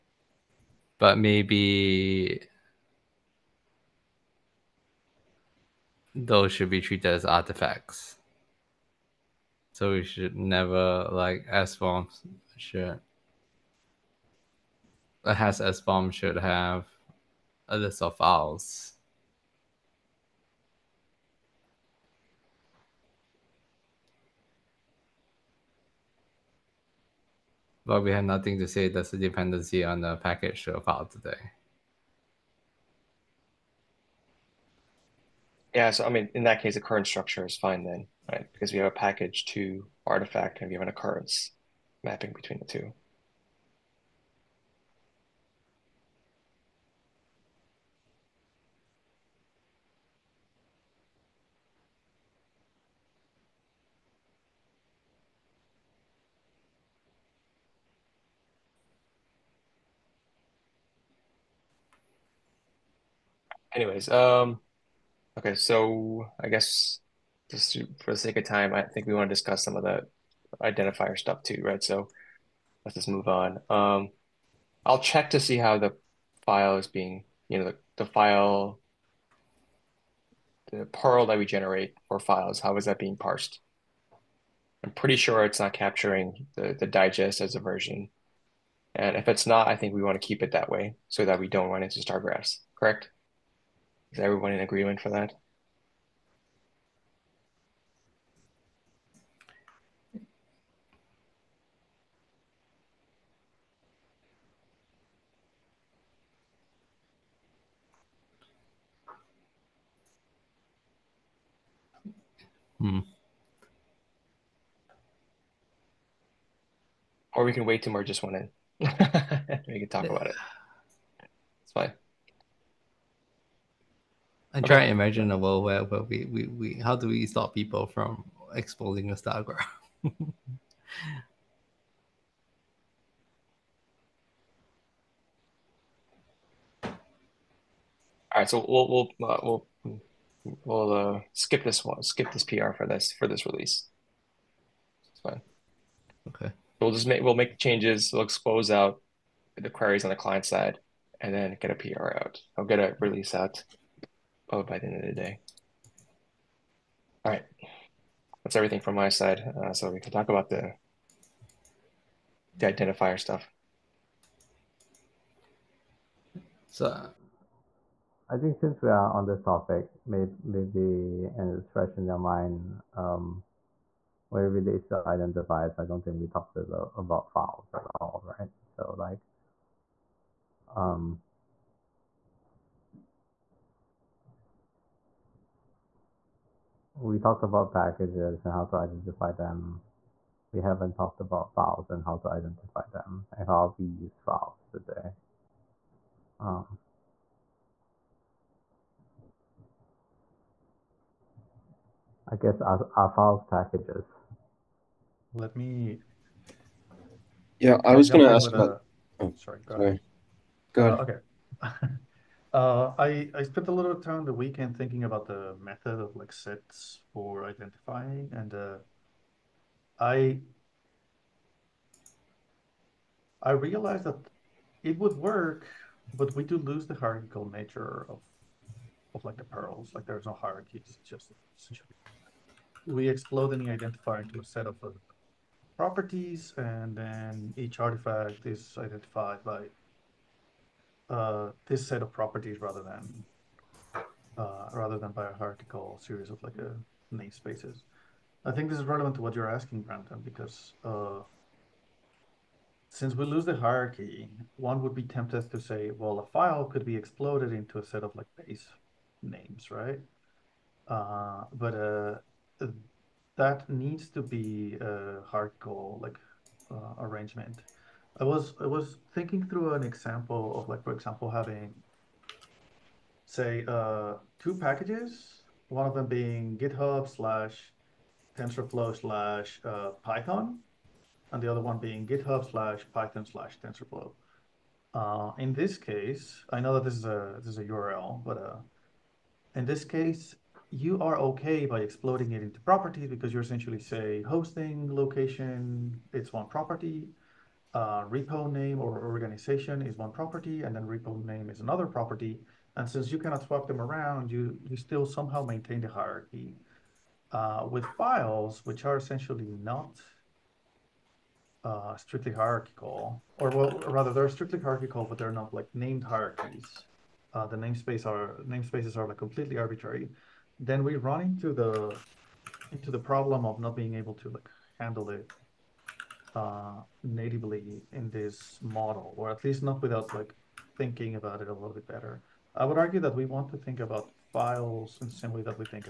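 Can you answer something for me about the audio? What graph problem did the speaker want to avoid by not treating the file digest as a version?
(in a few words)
Star graphs.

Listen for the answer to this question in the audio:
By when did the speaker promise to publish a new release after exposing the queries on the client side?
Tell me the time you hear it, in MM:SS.
02:34.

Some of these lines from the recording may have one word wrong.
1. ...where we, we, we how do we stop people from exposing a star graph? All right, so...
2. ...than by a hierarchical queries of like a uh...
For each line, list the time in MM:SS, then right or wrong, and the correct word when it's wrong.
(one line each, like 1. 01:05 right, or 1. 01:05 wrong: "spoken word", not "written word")
1. 02:05 right
2. 04:04 wrong: "series", not "queries".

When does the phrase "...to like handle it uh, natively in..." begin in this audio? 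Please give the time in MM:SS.
05:24.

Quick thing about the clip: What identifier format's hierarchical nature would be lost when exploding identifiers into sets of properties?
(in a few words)
purls.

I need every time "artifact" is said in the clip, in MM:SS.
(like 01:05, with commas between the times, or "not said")
00:07, 00:40, 03:57.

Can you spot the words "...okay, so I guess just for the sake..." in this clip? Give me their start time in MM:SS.
01:05.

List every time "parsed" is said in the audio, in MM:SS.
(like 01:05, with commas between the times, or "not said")
01:23.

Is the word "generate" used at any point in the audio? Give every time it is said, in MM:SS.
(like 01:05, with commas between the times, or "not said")
01:21.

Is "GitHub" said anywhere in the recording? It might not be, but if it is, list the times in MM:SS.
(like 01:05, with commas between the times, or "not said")
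04:36, 04:42.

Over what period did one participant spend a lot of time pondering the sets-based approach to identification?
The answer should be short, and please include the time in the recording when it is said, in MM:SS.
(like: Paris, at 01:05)
The weekend, at 03:34.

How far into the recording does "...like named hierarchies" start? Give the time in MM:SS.
05:15.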